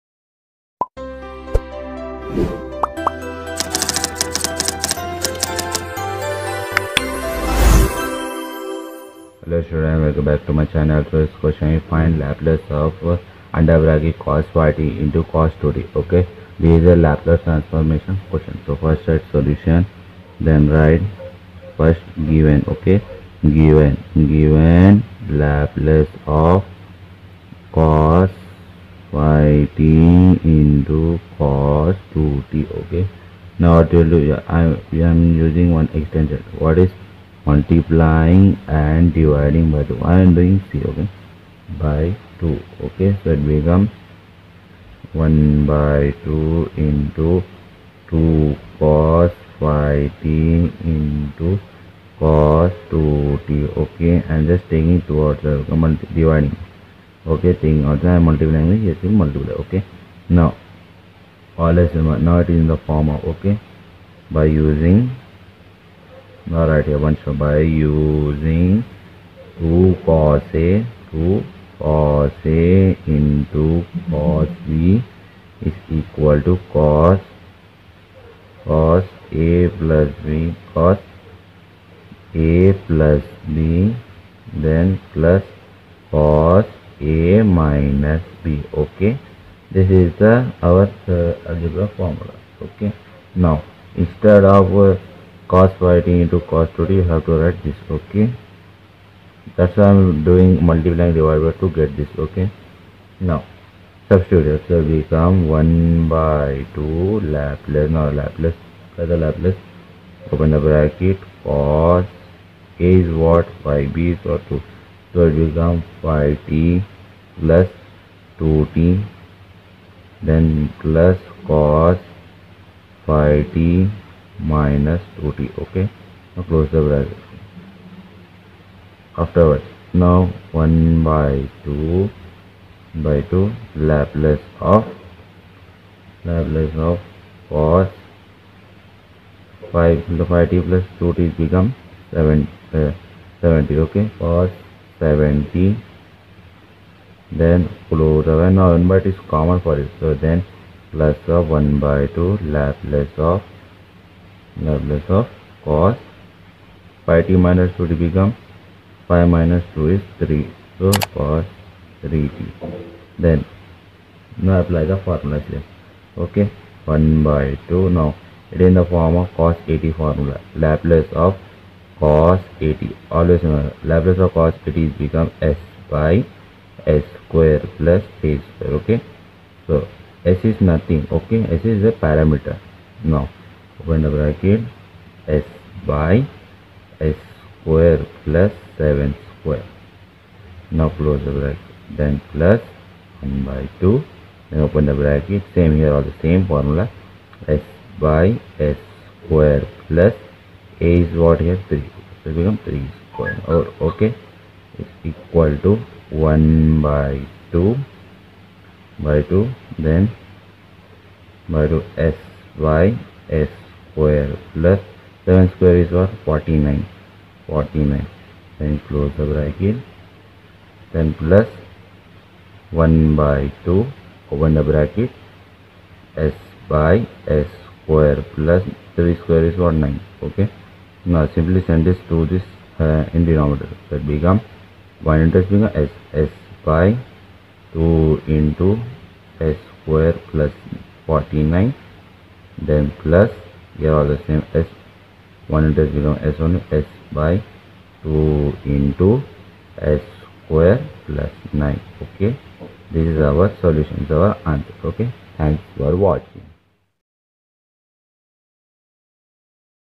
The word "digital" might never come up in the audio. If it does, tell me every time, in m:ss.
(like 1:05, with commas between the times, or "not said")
not said.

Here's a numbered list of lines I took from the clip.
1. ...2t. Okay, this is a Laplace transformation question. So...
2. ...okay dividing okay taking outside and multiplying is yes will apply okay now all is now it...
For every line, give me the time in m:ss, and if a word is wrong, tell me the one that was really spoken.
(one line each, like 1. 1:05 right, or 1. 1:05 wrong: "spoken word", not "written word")
1. 0:15 right
2. 0:55 wrong: "multiply", not "apply".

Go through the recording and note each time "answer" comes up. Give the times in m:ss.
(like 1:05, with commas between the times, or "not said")
4:14.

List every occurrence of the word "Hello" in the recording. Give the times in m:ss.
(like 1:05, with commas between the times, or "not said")
0:09.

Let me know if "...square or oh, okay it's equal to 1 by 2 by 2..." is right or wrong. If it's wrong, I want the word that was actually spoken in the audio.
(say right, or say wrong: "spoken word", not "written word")
right.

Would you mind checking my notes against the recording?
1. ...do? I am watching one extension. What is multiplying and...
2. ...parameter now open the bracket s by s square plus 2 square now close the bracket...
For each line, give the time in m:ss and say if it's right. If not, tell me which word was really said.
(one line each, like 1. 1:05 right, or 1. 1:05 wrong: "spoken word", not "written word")
1. 0:34 wrong: "using", not "watching"
2. 3:02 wrong: "7", not "2".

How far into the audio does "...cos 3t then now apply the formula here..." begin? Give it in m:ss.
2:41.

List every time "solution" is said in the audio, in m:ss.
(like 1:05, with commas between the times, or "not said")
0:19, 4:13.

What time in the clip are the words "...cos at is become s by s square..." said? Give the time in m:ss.
2:54.